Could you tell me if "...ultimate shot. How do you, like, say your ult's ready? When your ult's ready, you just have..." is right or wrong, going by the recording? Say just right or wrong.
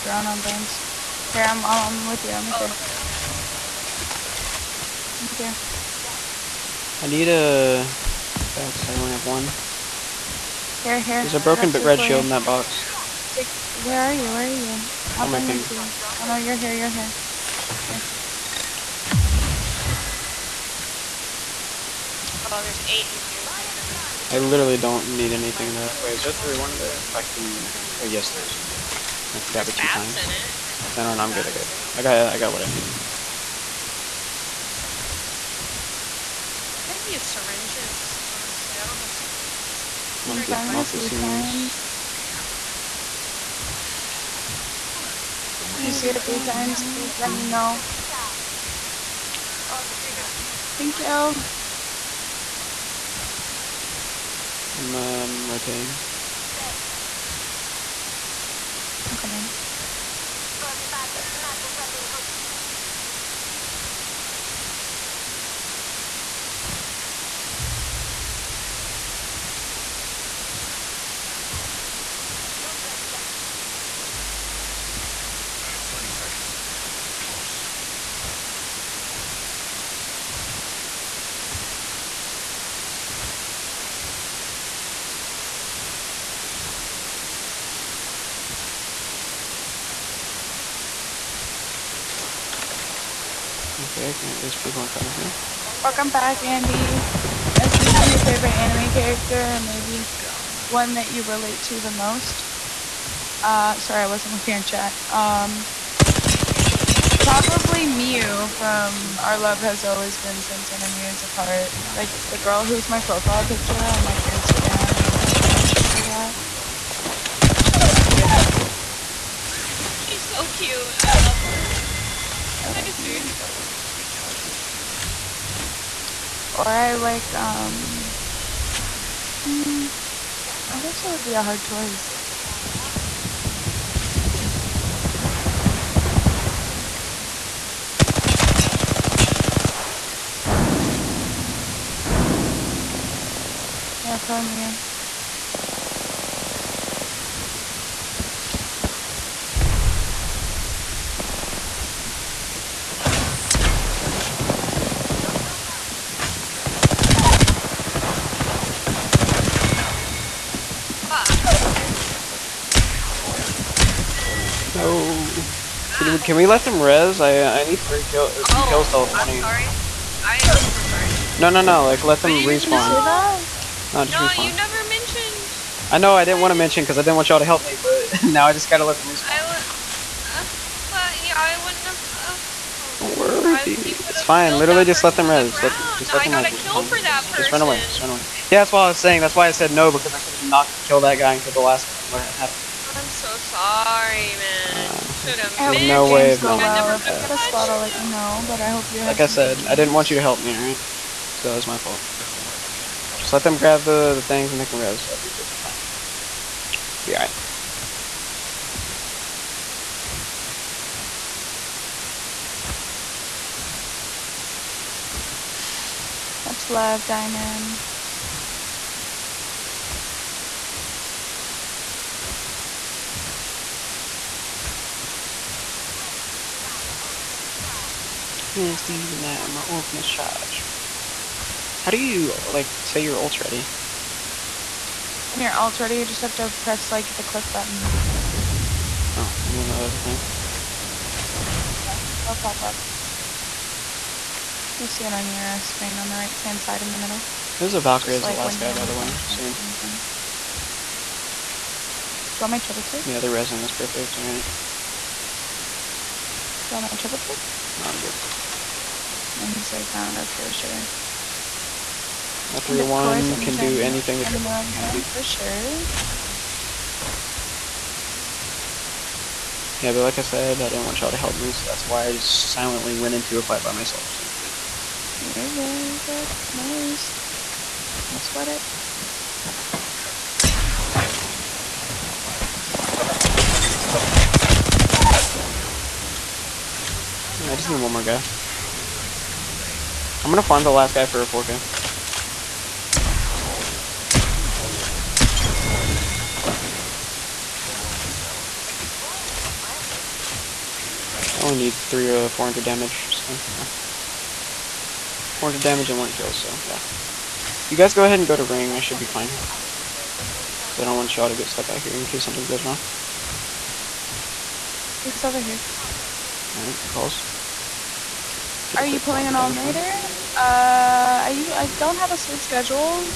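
right.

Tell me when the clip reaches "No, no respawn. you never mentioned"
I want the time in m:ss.
2:53.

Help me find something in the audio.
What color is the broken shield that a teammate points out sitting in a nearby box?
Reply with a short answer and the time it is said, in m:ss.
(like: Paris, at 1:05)
Red, at 0:11.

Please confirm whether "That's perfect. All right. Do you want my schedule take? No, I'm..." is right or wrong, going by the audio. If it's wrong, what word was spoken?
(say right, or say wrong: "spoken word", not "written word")
wrong: "triple", not "schedule".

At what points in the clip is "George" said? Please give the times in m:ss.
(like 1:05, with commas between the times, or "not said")
not said.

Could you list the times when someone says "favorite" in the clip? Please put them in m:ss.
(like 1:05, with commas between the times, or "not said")
1:38.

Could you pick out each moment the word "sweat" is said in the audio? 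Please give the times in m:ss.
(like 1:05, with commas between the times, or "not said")
4:38.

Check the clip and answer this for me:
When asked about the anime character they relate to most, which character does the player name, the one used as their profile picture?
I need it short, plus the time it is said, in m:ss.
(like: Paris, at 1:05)
Miu, at 1:47.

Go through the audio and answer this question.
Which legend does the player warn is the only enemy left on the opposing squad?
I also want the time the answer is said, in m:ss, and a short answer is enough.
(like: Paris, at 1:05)
Valkyrie, at 4:07.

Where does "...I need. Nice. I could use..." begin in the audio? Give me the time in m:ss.
0:32.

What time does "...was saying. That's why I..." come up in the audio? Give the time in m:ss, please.
3:08.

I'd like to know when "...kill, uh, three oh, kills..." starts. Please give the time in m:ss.
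2:48.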